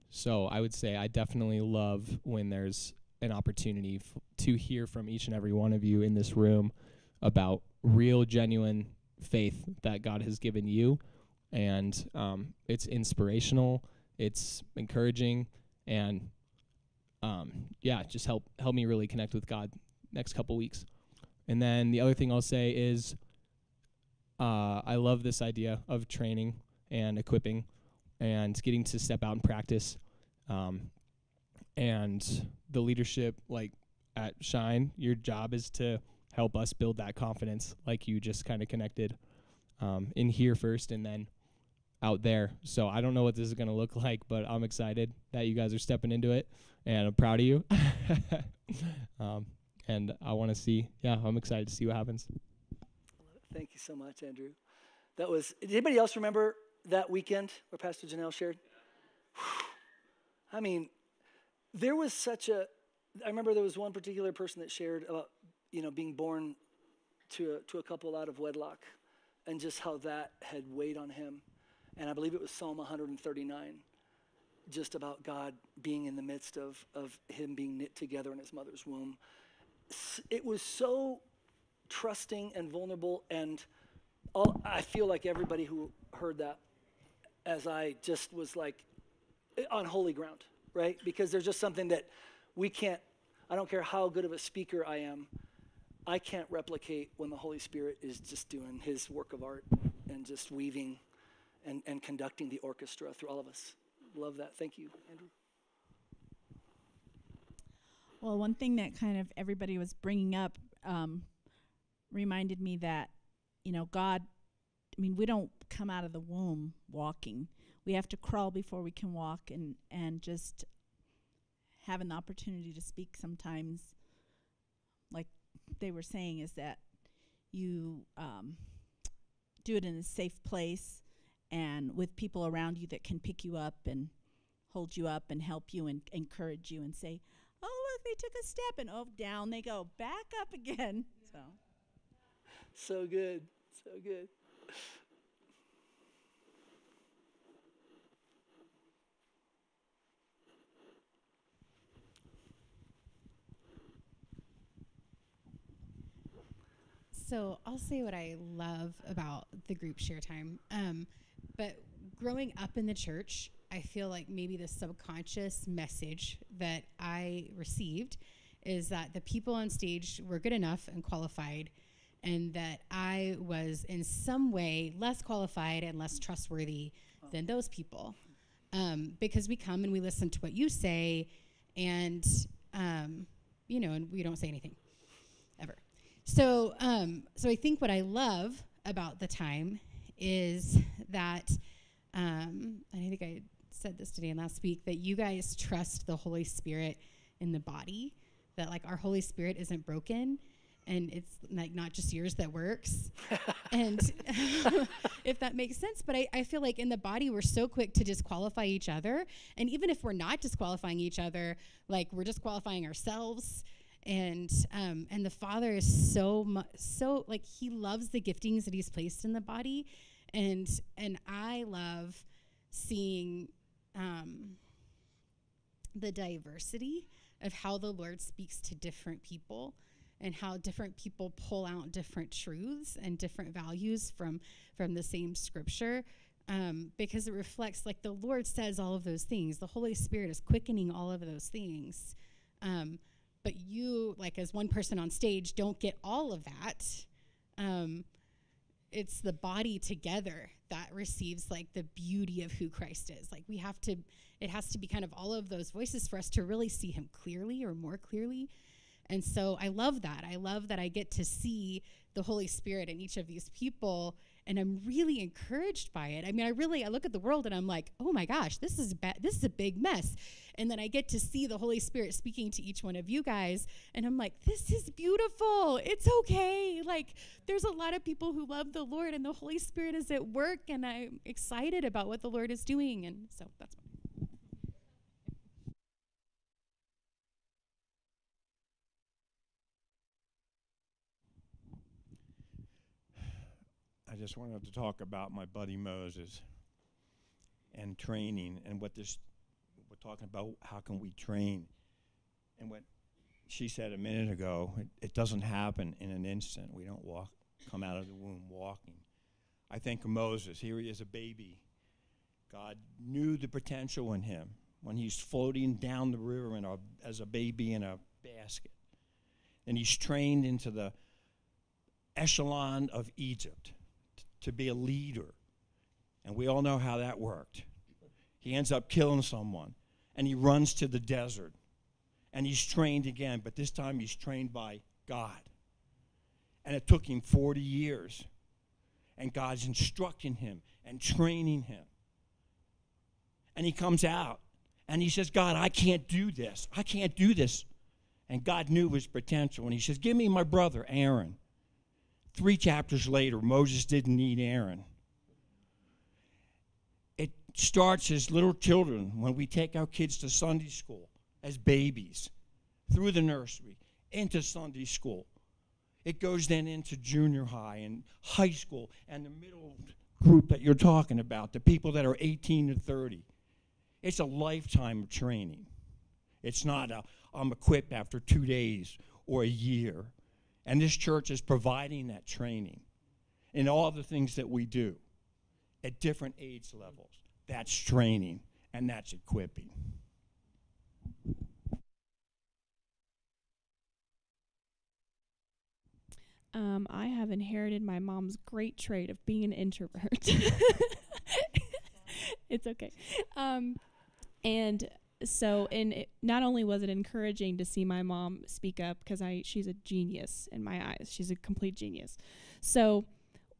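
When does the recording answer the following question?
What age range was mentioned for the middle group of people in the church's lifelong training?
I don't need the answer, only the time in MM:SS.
06:12.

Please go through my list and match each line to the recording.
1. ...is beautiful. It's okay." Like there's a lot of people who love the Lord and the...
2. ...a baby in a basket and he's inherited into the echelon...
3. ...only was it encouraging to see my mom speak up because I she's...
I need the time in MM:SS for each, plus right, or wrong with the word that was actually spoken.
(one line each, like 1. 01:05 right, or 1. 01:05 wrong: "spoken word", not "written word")
1. 04:34 right
2. 05:17 wrong: "trained", not "inherited"
3. 06:46 right.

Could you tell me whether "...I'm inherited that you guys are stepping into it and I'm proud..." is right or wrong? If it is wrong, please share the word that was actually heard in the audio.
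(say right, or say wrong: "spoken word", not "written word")
wrong: "excited", not "inherited".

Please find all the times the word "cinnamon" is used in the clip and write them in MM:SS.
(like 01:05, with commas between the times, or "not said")
not said.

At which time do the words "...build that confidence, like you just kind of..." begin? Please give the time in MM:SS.
00:36.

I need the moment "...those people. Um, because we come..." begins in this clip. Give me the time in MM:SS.
02:57.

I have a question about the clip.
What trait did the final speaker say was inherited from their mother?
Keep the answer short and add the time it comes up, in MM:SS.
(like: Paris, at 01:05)
being an introvert, at 06:39.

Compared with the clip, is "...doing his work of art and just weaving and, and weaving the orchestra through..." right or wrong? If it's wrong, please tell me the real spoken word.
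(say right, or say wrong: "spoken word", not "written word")
wrong: "conducting", not "weaving".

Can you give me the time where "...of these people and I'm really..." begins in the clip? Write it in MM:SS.
04:23.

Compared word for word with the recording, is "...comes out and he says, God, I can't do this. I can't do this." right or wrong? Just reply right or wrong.
right.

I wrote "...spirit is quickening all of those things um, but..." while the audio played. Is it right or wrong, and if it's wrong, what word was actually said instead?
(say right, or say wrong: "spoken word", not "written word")
right.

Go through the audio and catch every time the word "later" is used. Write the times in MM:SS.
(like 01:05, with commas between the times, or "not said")
05:53.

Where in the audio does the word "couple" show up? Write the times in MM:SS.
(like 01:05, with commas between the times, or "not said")
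00:20, 01:07.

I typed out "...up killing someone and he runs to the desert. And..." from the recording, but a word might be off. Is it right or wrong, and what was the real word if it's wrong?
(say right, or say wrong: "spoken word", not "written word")
right.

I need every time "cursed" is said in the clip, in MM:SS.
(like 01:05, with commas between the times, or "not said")
not said.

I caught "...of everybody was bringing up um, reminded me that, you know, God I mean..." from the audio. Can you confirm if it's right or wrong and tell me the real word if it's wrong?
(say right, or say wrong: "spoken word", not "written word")
right.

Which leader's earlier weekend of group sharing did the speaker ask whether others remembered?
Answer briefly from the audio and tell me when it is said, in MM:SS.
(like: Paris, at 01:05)
Pastor Janelle, at 00:57.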